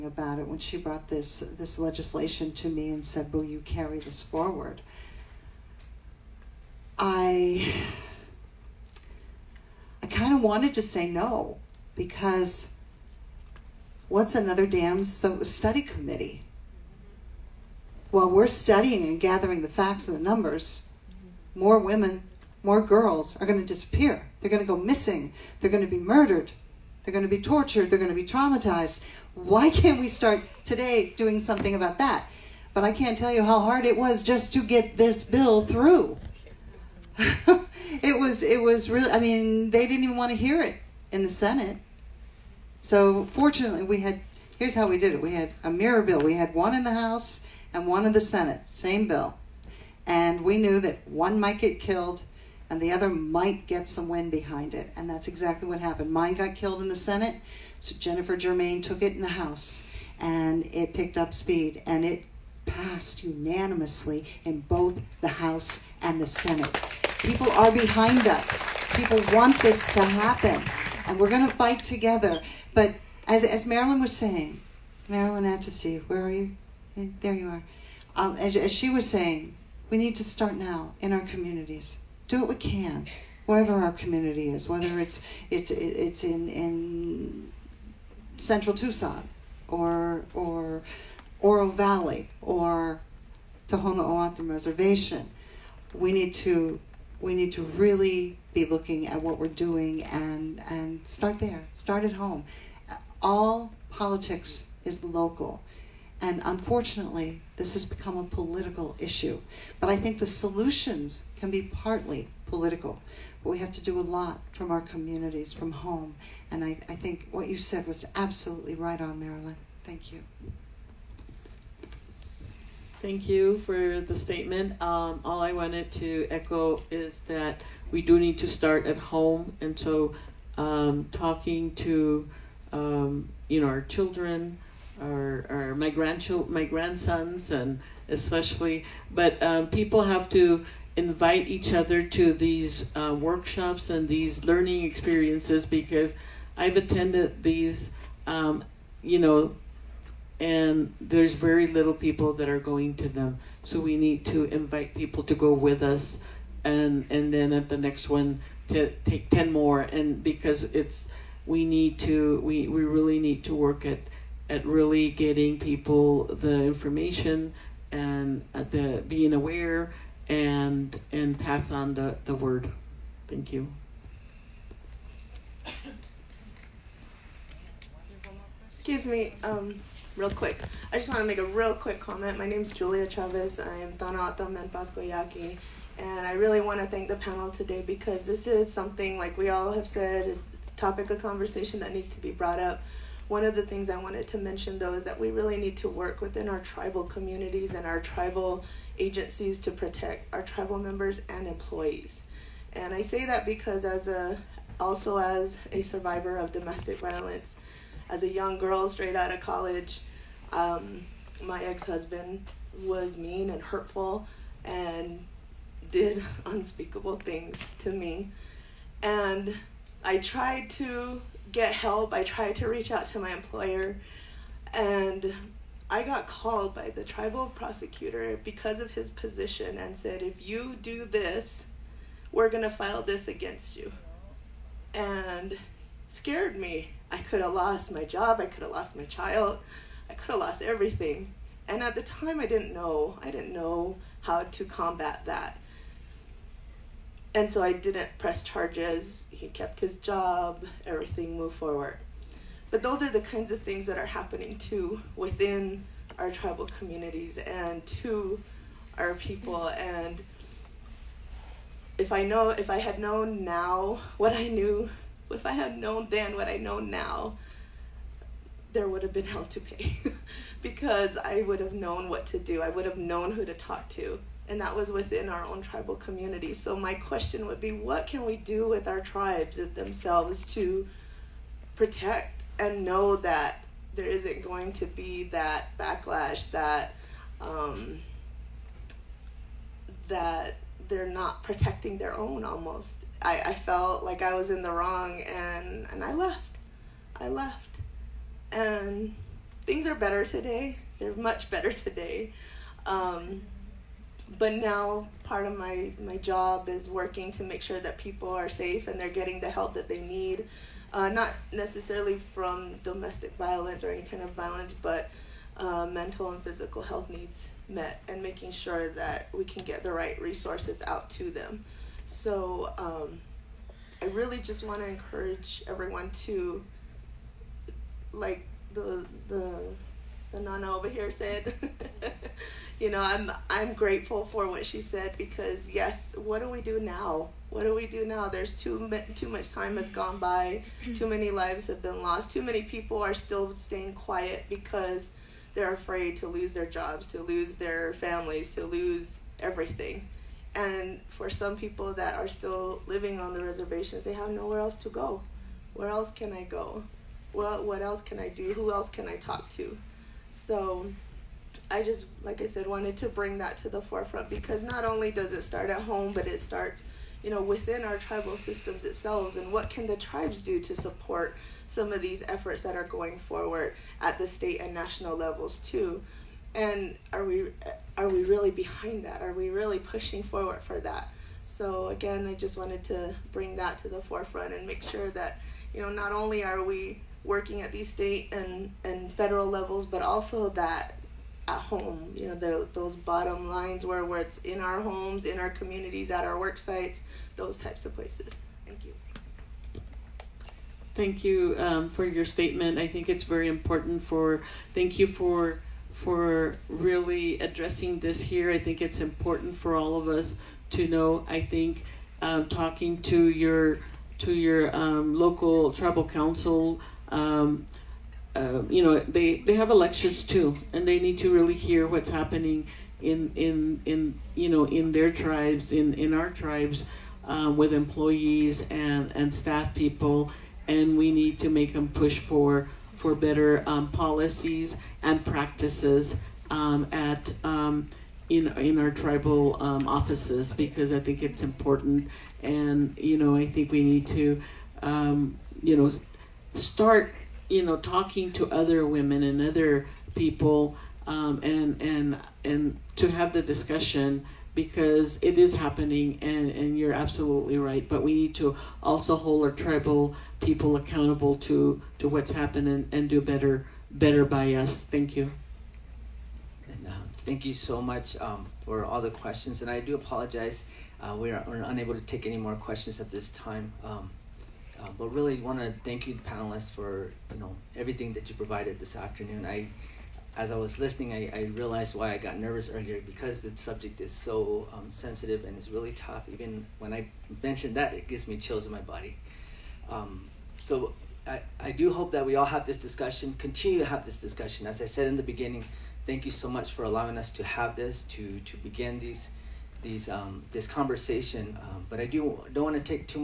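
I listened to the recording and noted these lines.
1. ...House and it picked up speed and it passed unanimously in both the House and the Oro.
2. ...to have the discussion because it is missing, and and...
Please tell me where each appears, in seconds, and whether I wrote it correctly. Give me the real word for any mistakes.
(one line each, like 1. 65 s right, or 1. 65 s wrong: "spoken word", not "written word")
1. 59 s wrong: "Senate", not "Oro"
2. 452 s wrong: "happening", not "missing".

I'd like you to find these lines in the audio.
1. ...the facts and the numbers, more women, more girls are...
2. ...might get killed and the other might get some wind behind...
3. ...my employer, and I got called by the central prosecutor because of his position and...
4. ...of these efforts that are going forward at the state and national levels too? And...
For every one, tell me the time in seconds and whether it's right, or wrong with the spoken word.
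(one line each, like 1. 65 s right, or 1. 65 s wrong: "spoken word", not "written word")
1. 19 s right
2. 51 s right
3. 223 s wrong: "tribal", not "central"
4. 371 s right.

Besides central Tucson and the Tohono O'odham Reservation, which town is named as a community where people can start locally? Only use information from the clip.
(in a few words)
Oro Valley.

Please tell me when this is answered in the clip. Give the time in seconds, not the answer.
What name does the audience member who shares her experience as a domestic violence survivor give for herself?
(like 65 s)
182 s.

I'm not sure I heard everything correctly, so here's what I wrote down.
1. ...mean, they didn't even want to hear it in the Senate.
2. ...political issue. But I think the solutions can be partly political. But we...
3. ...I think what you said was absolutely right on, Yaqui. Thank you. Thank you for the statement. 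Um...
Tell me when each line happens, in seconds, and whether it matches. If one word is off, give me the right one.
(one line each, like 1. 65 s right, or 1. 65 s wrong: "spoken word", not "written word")
1. 39 s right
2. 108 s right
3. 116 s wrong: "Marilyn", not "Yaqui".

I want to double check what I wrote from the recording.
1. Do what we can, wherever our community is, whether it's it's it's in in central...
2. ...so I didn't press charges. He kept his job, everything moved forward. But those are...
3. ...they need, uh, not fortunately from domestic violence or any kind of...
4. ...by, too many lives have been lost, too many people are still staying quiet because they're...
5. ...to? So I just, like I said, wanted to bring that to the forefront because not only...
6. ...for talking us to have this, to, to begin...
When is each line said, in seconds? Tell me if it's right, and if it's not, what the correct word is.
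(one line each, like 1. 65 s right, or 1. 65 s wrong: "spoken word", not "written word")
1. 82 s right
2. 247 s right
3. 309 s wrong: "necessarily", not "fortunately"
4. 340 s right
5. 359 s right
6. 496 s wrong: "allowing", not "talking".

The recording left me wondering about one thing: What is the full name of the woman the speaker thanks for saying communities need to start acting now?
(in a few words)
Marilyn Attasy.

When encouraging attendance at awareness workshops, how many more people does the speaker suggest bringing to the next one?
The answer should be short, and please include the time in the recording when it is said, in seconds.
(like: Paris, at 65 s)
10, at 159 s.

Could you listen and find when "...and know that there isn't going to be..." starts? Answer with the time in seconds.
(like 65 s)
282 s.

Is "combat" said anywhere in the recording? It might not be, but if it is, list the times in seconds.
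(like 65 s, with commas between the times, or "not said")
244 s.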